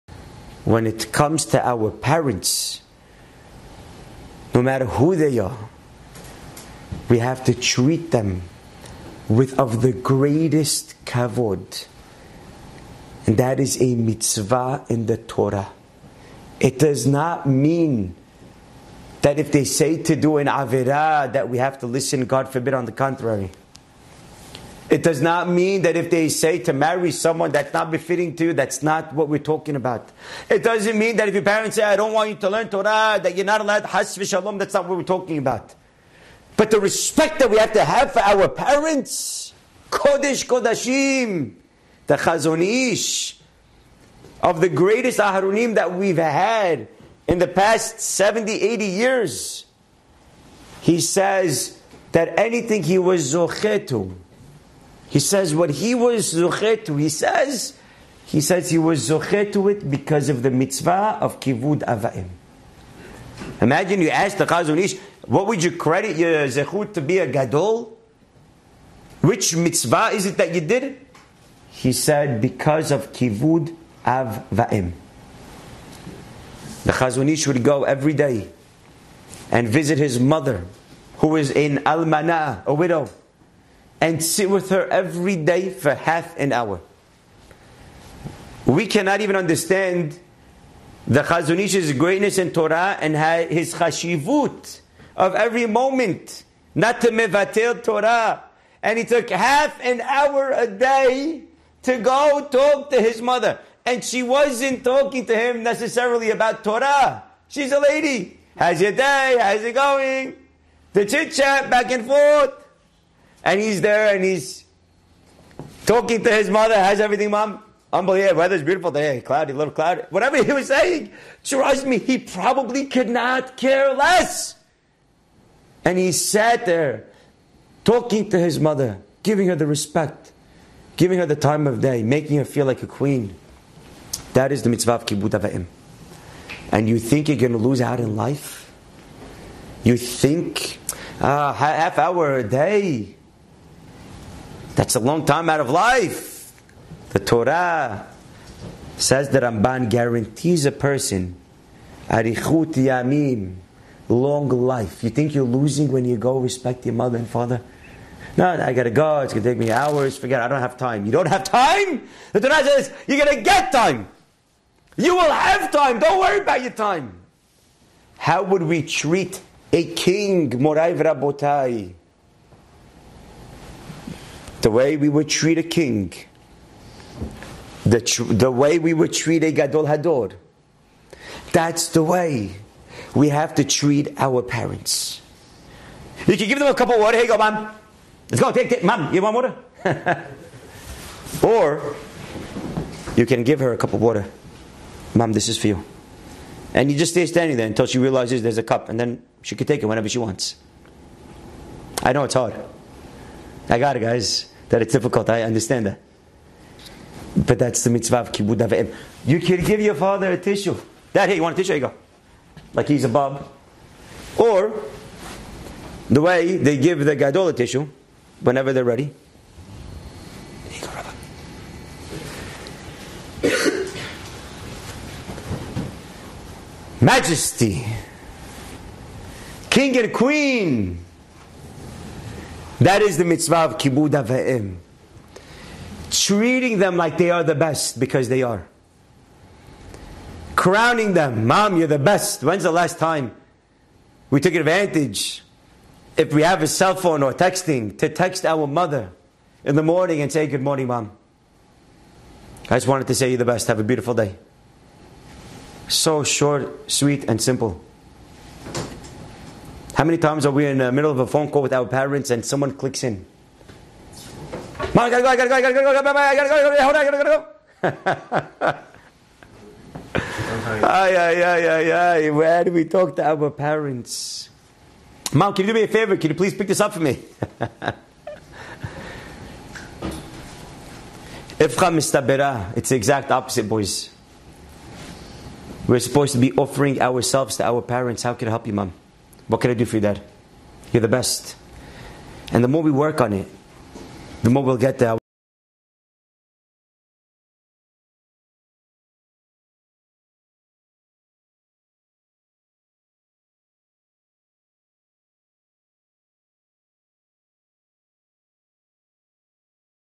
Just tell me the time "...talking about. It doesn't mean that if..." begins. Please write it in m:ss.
0:29.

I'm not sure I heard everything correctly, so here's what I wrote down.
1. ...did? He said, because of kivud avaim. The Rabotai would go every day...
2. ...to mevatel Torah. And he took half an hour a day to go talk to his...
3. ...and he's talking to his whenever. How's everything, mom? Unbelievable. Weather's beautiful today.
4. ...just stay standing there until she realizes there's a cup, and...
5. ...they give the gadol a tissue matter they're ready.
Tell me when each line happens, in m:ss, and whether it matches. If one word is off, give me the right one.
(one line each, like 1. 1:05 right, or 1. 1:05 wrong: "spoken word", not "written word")
1. 1:10 wrong: "Chazonish", not "Rabotai"
2. 1:37 right
3. 1:54 wrong: "mother", not "whenever"
4. 3:16 right
5. 3:36 wrong: "whenever", not "matter".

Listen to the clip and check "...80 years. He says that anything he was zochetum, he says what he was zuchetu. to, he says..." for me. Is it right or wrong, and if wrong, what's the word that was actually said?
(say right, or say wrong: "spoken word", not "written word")
right.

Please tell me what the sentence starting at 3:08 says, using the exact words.
Take, it, Mom, you want water?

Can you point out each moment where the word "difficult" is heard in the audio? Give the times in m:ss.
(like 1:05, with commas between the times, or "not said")
3:24.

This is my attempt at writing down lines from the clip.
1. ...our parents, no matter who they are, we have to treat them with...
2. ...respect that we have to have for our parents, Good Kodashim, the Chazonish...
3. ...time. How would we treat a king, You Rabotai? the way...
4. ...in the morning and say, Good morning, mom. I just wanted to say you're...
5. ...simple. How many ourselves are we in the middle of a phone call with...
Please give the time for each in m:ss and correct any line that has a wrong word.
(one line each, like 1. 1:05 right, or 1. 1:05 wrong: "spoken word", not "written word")
1. 0:01 right
2. 0:36 wrong: "Kodesh", not "Good"
3. 2:46 wrong: "Moray", not "You"
4. 4:09 right
5. 4:17 wrong: "times", not "ourselves".